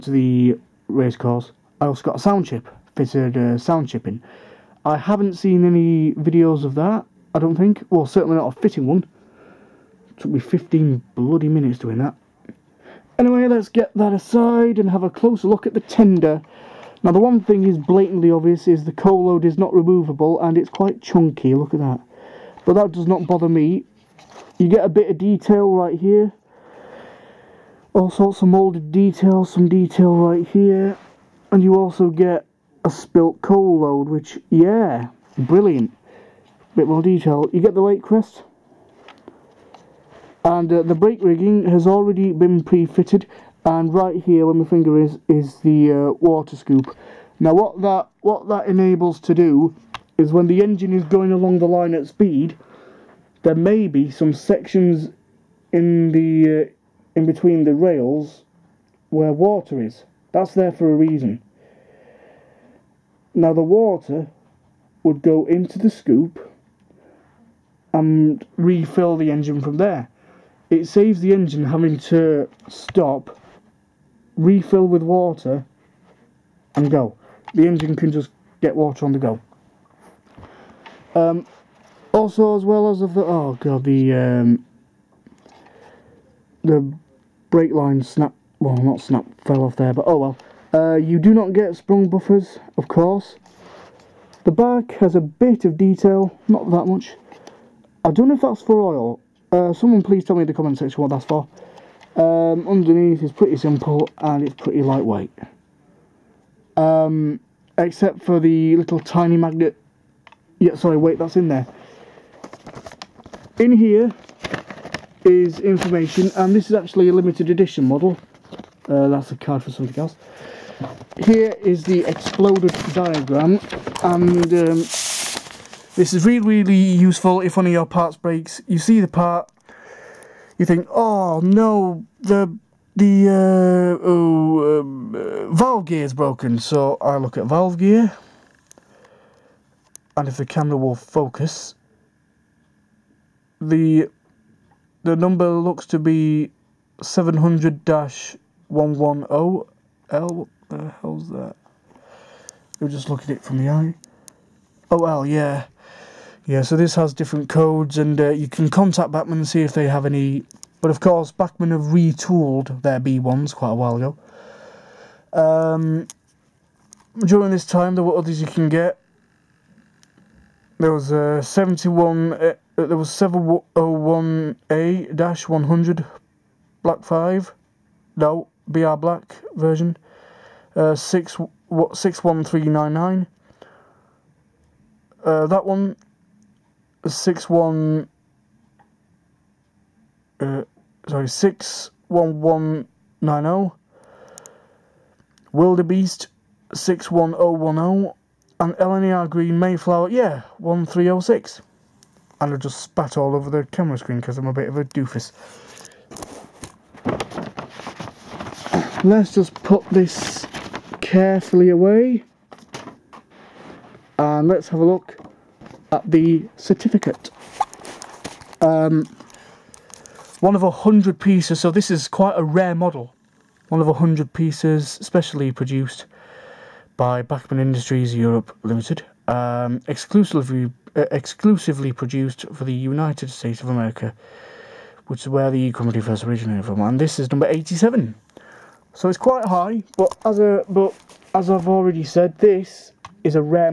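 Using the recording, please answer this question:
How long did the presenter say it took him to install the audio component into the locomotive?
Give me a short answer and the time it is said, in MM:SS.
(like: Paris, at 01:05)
15 minutes, at 00:10.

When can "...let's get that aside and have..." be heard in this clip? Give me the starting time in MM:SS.
00:13.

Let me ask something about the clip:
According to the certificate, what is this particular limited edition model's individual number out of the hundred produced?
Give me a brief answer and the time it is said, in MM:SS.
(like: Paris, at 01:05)
87, at 03:57.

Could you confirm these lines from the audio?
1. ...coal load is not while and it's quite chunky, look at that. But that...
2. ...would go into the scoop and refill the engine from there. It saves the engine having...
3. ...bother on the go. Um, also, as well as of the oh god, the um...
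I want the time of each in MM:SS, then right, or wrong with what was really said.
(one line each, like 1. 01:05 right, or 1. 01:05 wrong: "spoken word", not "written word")
1. 00:18 wrong: "removable", not "while"
2. 01:05 right
3. 01:18 wrong: "water", not "bother".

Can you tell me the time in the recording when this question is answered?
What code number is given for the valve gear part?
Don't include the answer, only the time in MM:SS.
02:27.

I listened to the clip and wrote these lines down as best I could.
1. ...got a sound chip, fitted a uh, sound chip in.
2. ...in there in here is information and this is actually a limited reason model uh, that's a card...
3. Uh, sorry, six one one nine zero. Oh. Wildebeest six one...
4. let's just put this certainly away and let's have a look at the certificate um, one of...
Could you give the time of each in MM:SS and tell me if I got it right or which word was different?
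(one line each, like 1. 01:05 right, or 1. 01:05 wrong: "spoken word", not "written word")
1. 00:02 right
2. 01:51 wrong: "edition", not "reason"
3. 03:10 right
4. 03:29 wrong: "carefully", not "certainly".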